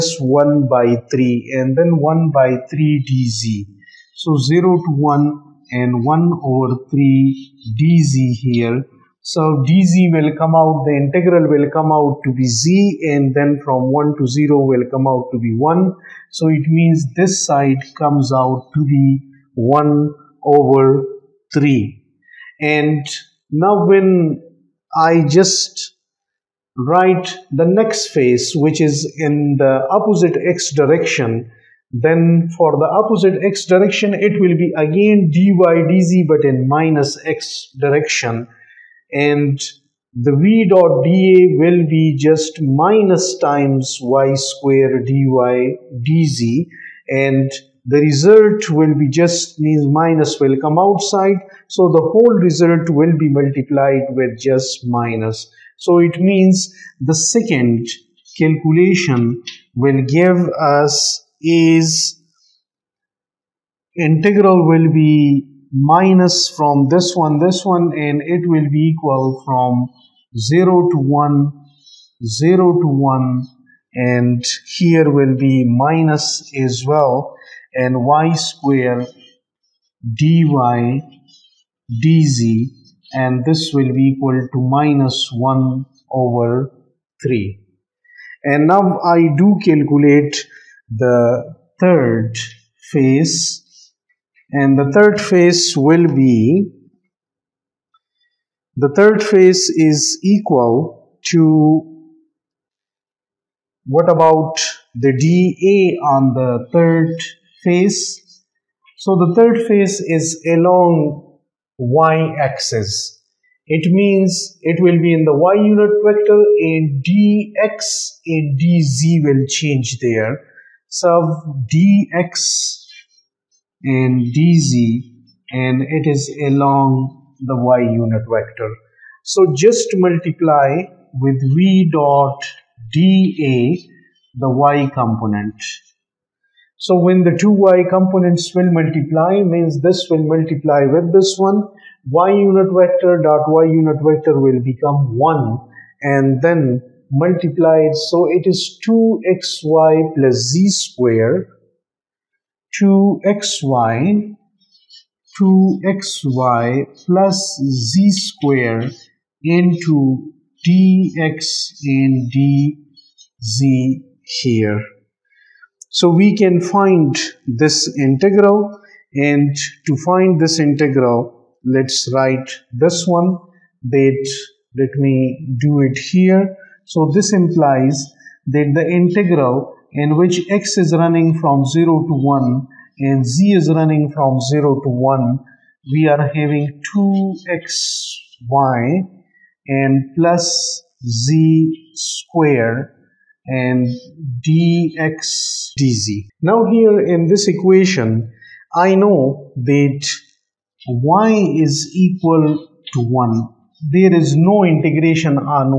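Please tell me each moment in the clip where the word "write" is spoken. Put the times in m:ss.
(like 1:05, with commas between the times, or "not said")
0:26, 2:52.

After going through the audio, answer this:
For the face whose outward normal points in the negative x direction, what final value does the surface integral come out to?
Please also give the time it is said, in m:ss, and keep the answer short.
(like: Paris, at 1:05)
-1/3, at 1:24.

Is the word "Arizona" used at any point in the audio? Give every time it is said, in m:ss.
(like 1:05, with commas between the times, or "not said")
not said.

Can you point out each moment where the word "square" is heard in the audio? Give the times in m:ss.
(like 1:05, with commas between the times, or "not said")
0:44, 1:18, 2:30, 2:38, 3:11.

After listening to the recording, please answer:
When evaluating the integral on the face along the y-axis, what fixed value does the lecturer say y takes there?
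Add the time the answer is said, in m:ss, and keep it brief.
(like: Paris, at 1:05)
1, at 3:20.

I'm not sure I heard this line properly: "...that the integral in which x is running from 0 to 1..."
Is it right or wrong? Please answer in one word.
right.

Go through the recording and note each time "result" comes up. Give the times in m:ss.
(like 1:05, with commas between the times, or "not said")
0:48, 0:52.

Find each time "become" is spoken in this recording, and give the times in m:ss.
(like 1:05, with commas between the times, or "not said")
2:24.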